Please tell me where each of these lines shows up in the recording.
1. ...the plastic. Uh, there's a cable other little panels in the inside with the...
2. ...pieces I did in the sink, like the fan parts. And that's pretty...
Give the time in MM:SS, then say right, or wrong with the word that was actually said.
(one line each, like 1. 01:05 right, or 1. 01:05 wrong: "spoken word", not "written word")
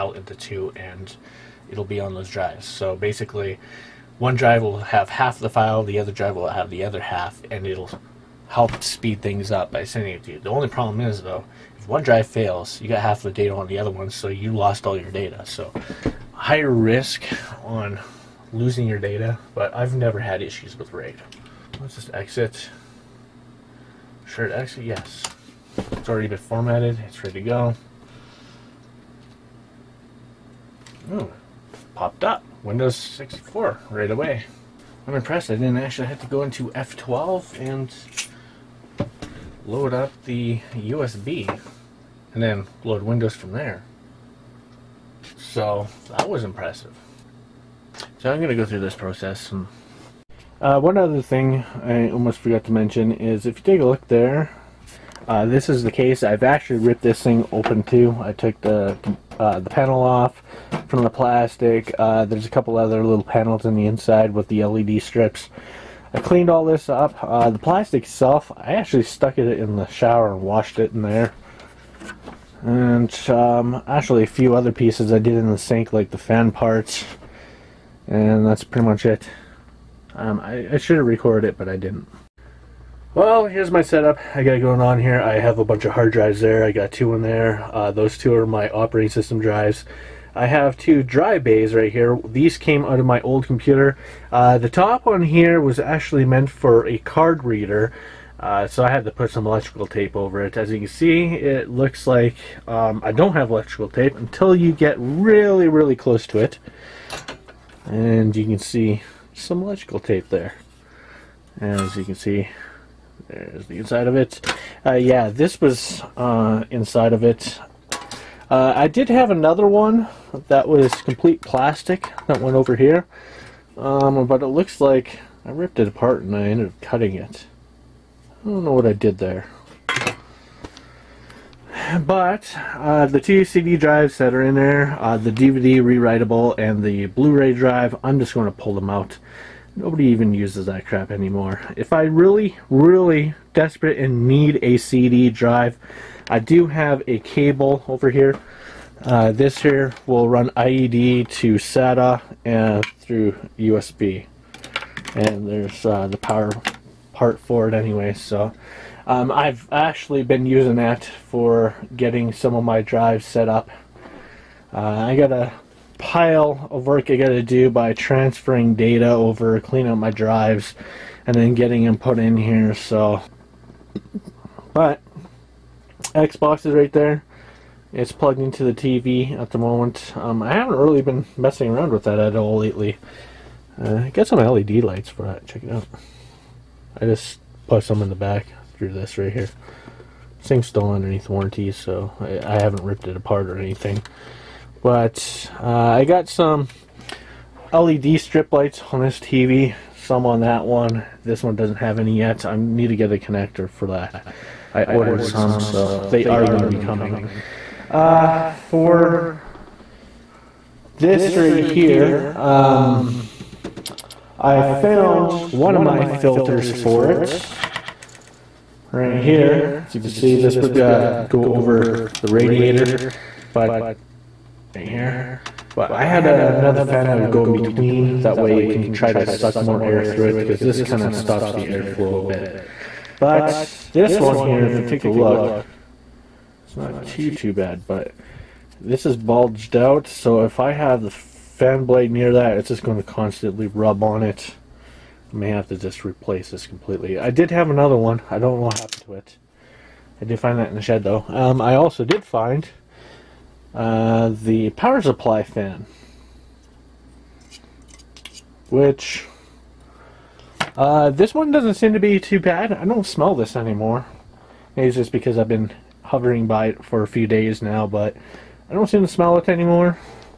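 1. 01:01 wrong: "couple", not "cable"
2. 01:14 right.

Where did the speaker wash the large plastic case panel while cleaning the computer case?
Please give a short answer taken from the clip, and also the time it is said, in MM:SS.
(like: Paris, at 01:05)
In the shower, at 01:09.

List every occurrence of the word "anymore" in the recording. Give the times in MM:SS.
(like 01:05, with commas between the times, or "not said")
02:21, 04:23, 04:29.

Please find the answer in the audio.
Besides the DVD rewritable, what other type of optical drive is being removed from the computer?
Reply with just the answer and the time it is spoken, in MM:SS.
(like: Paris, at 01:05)
Blu-ray drive, at 02:17.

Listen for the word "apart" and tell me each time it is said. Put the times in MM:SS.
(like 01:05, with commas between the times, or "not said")
02:05, 03:13.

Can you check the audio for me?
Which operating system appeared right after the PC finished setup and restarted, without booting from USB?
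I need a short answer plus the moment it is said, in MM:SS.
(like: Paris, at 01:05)
Windows 64, at 00:32.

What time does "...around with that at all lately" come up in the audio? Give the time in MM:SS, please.
03:01.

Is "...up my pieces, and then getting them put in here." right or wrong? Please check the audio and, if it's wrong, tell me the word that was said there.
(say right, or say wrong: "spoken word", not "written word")
wrong: "drives", not "pieces".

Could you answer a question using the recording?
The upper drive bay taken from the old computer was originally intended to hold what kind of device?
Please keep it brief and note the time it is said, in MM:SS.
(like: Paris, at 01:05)
A card reader, at 01:36.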